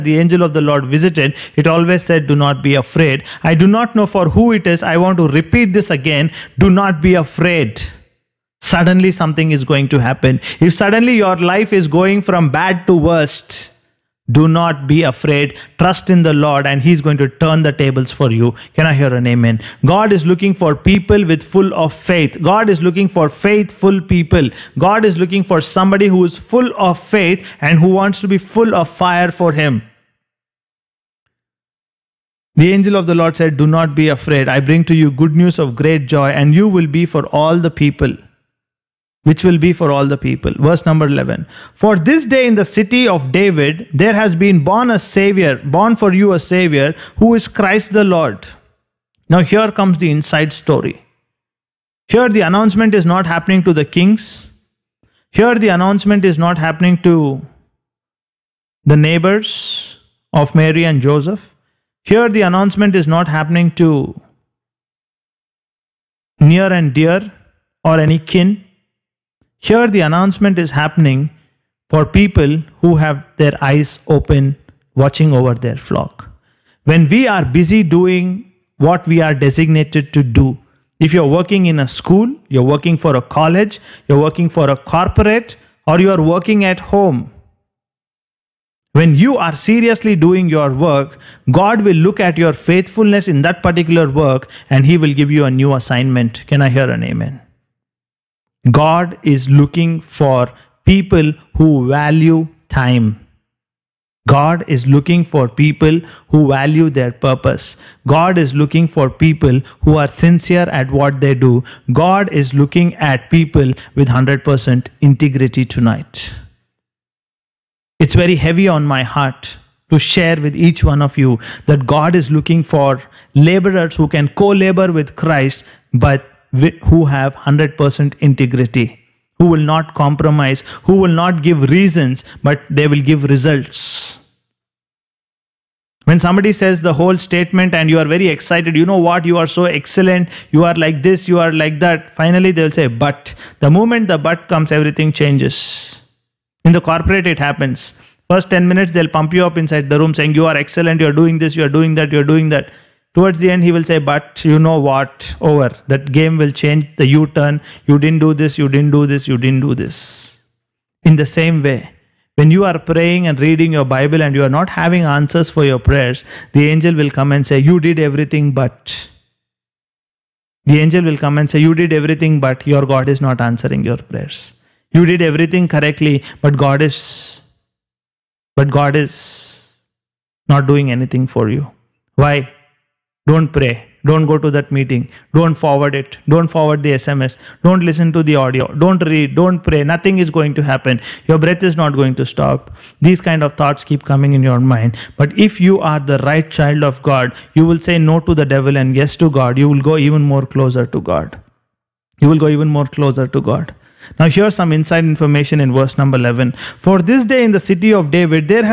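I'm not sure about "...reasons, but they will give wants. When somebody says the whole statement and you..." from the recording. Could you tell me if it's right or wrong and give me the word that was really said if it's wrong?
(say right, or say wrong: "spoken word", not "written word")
wrong: "results", not "wants".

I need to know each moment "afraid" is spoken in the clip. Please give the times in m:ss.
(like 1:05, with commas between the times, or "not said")
0:02, 0:07, 0:15, 0:34.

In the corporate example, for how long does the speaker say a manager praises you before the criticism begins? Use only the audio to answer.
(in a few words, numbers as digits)
10 minutes.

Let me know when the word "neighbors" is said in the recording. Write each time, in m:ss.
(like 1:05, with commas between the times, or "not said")
0:58.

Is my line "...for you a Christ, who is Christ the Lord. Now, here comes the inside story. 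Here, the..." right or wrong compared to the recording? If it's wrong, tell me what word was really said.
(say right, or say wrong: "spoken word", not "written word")
wrong: "Savior", not "Christ".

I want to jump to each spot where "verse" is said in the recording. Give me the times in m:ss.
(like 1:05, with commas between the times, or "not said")
0:40, 3:25.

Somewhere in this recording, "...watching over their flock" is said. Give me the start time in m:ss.
1:14.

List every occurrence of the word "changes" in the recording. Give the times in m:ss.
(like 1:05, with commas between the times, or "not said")
2:25, 2:36.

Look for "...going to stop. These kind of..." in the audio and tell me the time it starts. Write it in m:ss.
3:11.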